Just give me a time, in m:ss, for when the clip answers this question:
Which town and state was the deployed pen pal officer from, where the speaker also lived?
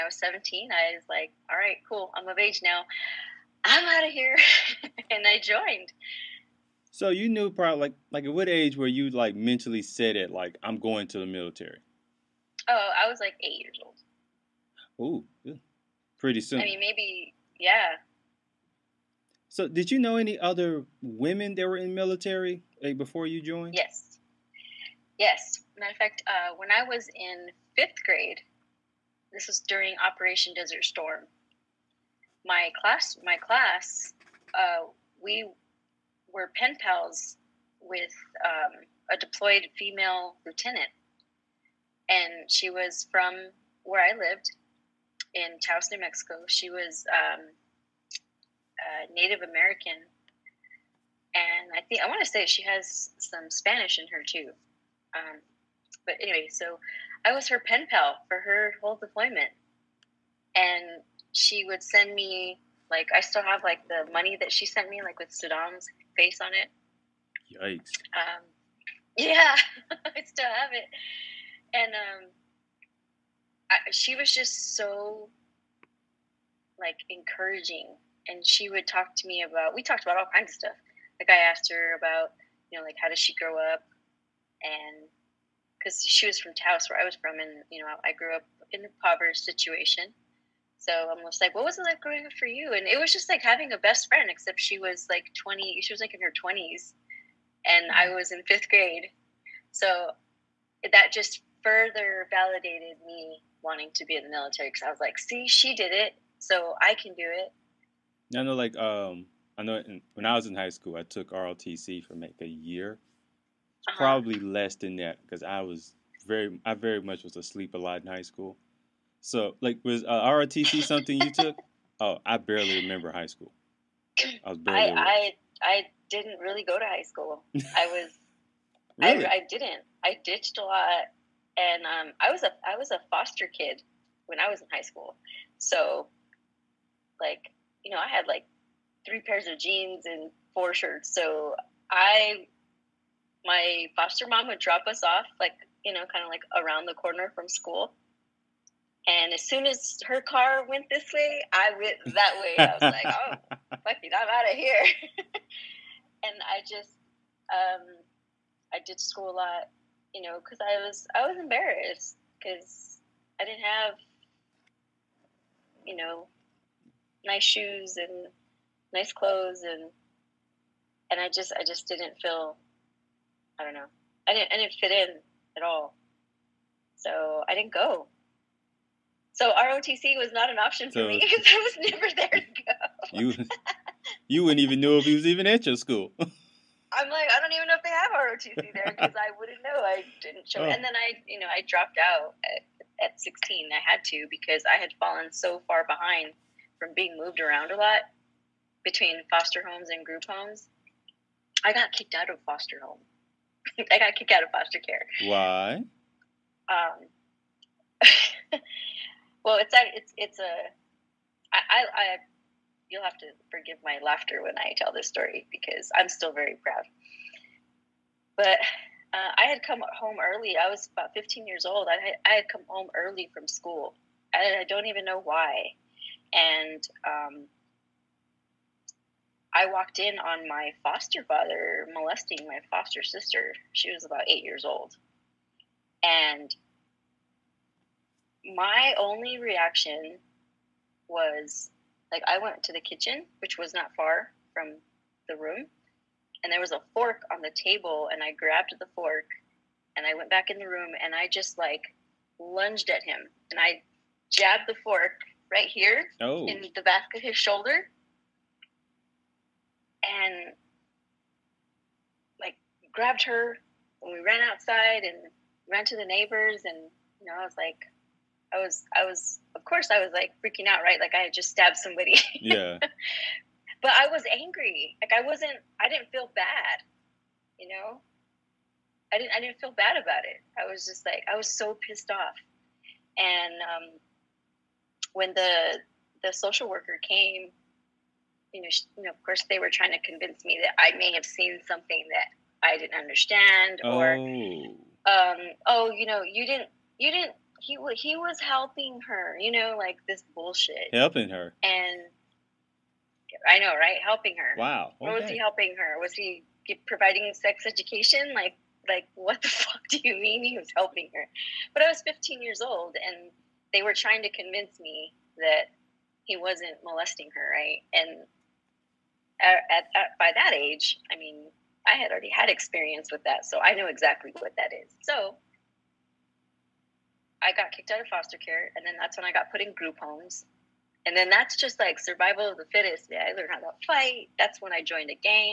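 0:45.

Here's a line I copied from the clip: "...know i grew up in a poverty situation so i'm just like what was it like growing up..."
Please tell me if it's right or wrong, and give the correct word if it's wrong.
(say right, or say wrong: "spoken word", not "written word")
right.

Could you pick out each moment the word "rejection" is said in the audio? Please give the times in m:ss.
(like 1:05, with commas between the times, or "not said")
not said.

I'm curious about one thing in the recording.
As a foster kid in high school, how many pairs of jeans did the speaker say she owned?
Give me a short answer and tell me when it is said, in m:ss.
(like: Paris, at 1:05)
3, at 2:19.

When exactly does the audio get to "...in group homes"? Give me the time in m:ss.
5:29.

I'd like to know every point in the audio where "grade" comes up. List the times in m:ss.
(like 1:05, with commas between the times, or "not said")
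0:28, 1:38.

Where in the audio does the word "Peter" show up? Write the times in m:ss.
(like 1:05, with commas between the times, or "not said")
not said.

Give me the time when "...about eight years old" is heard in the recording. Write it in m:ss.
3:54.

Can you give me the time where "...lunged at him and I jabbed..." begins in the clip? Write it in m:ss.
4:12.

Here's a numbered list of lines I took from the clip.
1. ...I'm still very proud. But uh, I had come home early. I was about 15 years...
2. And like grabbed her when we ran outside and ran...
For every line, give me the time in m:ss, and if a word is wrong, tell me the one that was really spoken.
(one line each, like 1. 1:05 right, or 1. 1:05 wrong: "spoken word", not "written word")
1. 3:35 right
2. 4:20 right.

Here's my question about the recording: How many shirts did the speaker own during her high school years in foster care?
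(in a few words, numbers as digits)
4.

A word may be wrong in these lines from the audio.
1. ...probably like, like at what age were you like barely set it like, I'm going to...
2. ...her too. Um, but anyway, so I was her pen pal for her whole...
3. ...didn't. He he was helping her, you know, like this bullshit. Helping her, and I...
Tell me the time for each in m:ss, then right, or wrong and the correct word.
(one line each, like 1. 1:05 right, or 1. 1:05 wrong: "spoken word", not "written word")
1. 0:07 wrong: "mentally", not "barely"
2. 0:54 right
3. 4:57 right.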